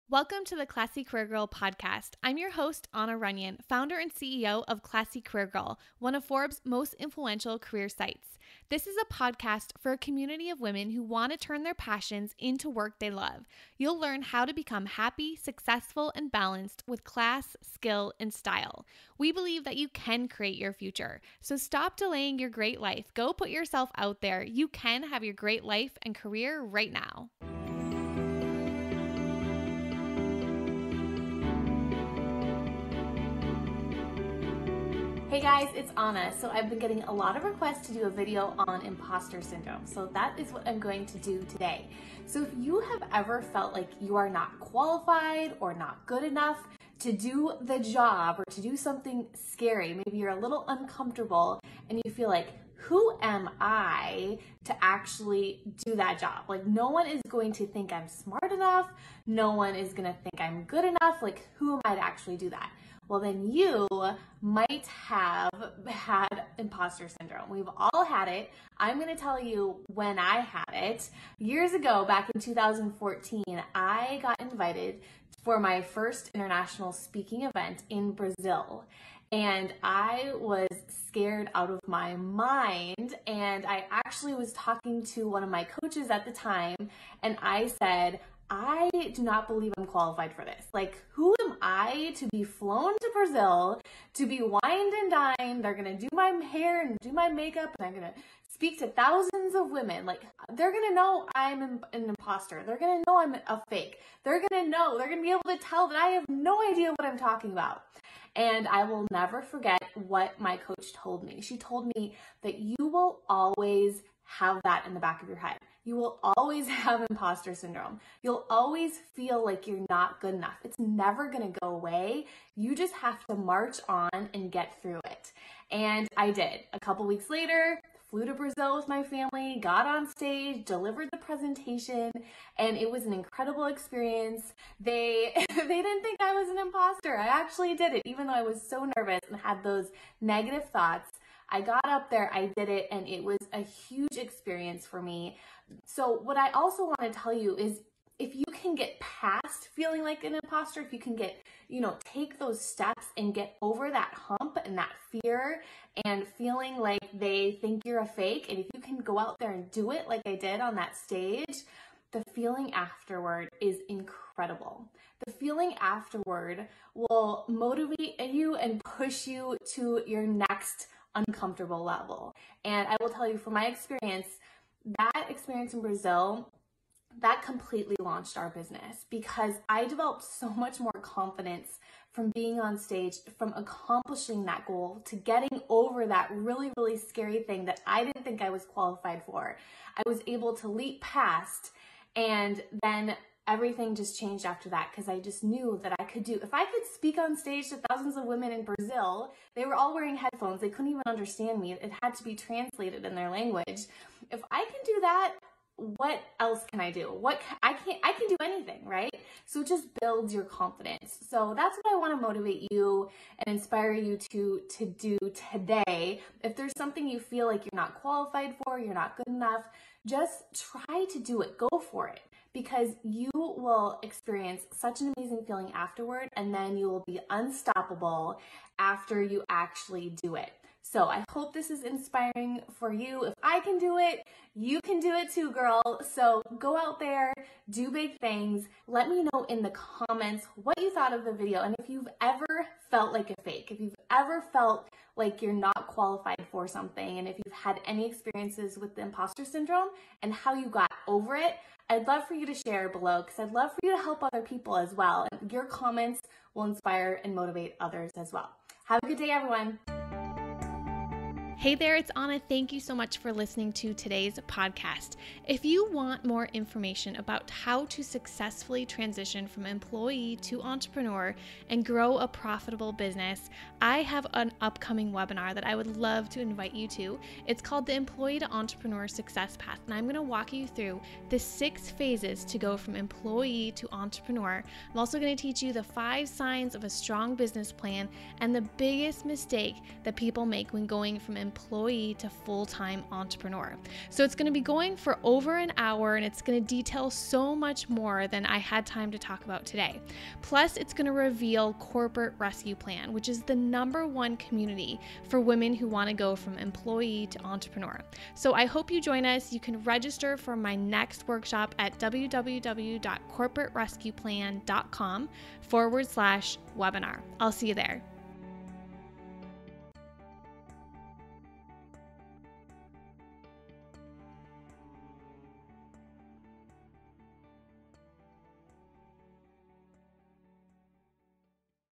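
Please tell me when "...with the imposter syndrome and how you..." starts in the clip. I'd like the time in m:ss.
4:08.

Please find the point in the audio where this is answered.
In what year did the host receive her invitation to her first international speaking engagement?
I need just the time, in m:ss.
1:12.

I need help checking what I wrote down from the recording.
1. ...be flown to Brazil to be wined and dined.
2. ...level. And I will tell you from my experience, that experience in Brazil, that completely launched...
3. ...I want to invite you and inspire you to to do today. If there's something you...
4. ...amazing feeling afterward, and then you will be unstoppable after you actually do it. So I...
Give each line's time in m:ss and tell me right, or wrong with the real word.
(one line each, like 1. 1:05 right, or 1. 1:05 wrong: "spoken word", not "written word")
1. 1:32 right
2. 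2:51 right
3. 3:31 wrong: "motivate", not "invite"
4. 3:45 right.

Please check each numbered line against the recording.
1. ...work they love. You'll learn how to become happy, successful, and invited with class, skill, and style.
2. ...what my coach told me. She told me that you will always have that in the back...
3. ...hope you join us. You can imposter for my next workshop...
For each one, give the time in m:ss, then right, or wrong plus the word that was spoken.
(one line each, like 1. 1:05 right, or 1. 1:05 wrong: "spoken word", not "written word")
1. 0:12 wrong: "balanced", not "invited"
2. 1:50 right
3. 5:08 wrong: "register", not "imposter".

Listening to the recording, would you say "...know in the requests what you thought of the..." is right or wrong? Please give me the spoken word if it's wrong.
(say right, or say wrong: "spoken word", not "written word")
wrong: "comments", not "requests".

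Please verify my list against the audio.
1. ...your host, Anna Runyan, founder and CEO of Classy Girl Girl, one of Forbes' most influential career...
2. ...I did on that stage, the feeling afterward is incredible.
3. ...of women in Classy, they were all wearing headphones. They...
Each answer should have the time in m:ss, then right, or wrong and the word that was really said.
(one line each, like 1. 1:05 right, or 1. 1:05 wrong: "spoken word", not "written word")
1. 0:02 wrong: "Career", not "Girl"
2. 2:40 right
3. 3:18 wrong: "Brazil", not "Classy".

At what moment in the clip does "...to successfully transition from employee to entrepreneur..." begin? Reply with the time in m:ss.
4:27.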